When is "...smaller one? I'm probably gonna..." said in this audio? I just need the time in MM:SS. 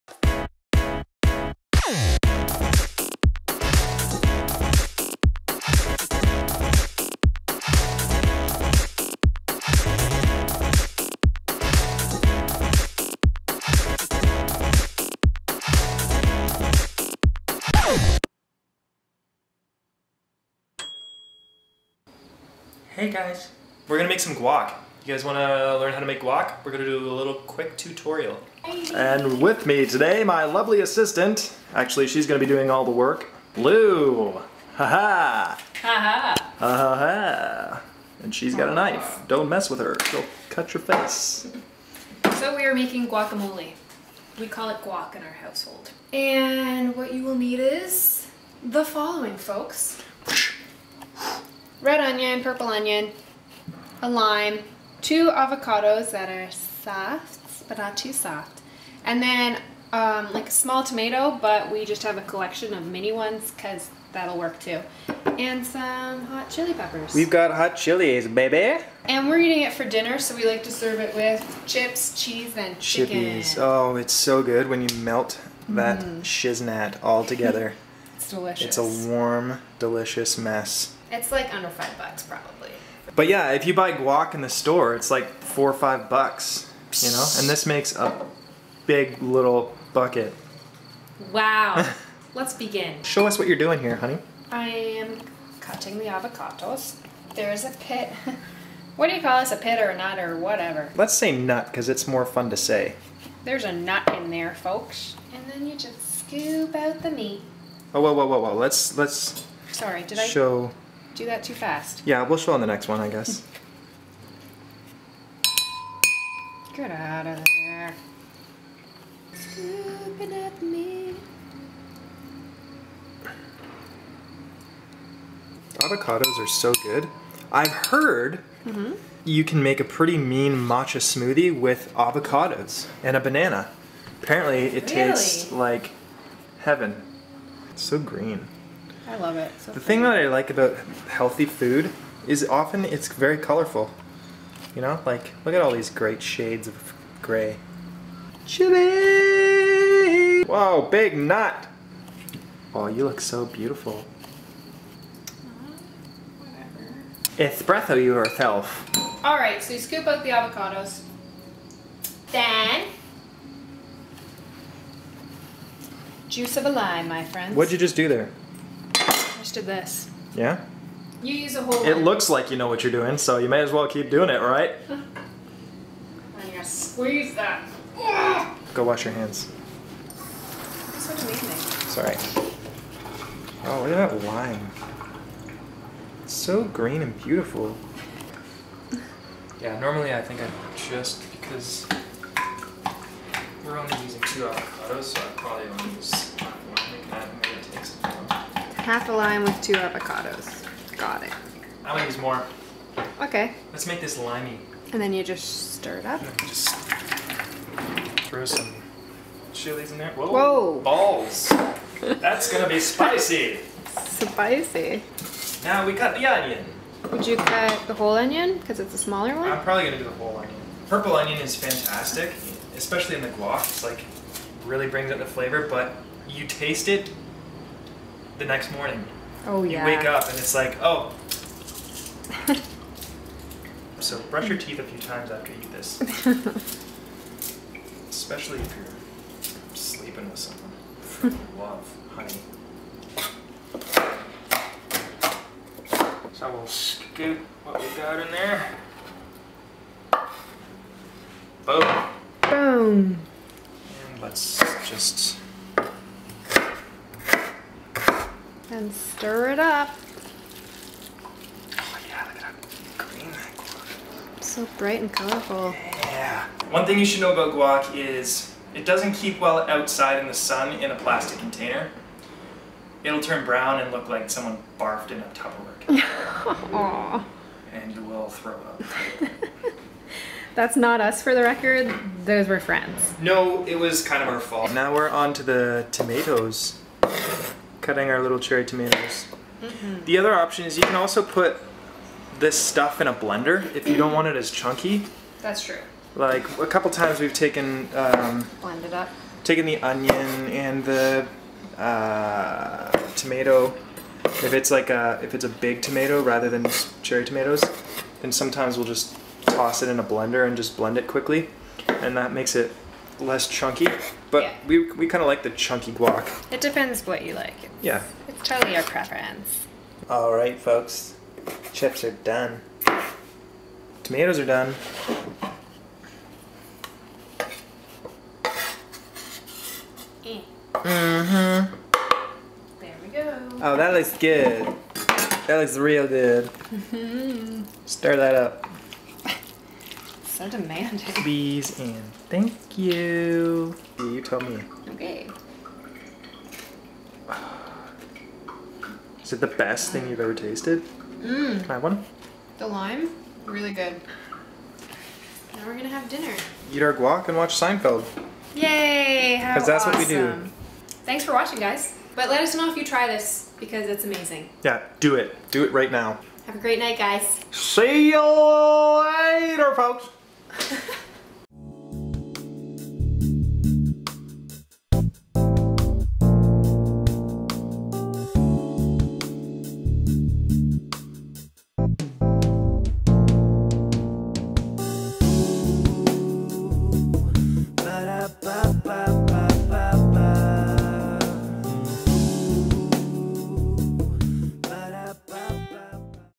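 03:38.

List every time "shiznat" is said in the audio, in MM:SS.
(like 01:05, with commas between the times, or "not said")
01:16.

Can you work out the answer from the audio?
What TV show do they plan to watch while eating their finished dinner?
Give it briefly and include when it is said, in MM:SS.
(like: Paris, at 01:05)
Seinfeld, at 05:57.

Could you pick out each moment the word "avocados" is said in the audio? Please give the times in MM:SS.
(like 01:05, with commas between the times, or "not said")
00:55, 01:36, 02:05, 02:11, 02:40, 03:14, 03:19.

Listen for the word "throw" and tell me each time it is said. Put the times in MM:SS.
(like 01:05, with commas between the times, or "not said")
03:28, 04:38.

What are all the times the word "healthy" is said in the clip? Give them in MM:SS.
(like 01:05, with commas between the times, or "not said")
02:21.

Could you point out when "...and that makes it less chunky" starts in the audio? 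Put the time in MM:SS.
05:11.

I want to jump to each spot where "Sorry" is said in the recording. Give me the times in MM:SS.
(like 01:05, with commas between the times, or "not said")
01:49, 03:01.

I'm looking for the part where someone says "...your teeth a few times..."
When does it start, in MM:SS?
03:54.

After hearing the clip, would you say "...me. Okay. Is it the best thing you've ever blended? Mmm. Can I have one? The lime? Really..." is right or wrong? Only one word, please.
wrong.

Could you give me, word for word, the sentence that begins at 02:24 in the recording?
You know, like look at all these great shades of gray.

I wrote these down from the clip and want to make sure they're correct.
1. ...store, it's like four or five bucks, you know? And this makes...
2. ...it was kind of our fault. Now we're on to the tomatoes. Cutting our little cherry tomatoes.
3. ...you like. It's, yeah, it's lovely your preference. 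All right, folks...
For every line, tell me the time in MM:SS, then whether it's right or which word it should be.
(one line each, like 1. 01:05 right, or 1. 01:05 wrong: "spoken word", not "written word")
1. 01:24 right
2. 04:43 right
3. 05:17 wrong: "totally", not "lovely".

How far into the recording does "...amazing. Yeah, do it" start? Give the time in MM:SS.
06:04.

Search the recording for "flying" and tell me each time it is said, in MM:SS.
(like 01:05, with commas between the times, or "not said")
not said.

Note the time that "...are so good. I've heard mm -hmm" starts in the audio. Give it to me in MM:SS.
02:06.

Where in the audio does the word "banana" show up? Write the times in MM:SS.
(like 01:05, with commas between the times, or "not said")
02:13.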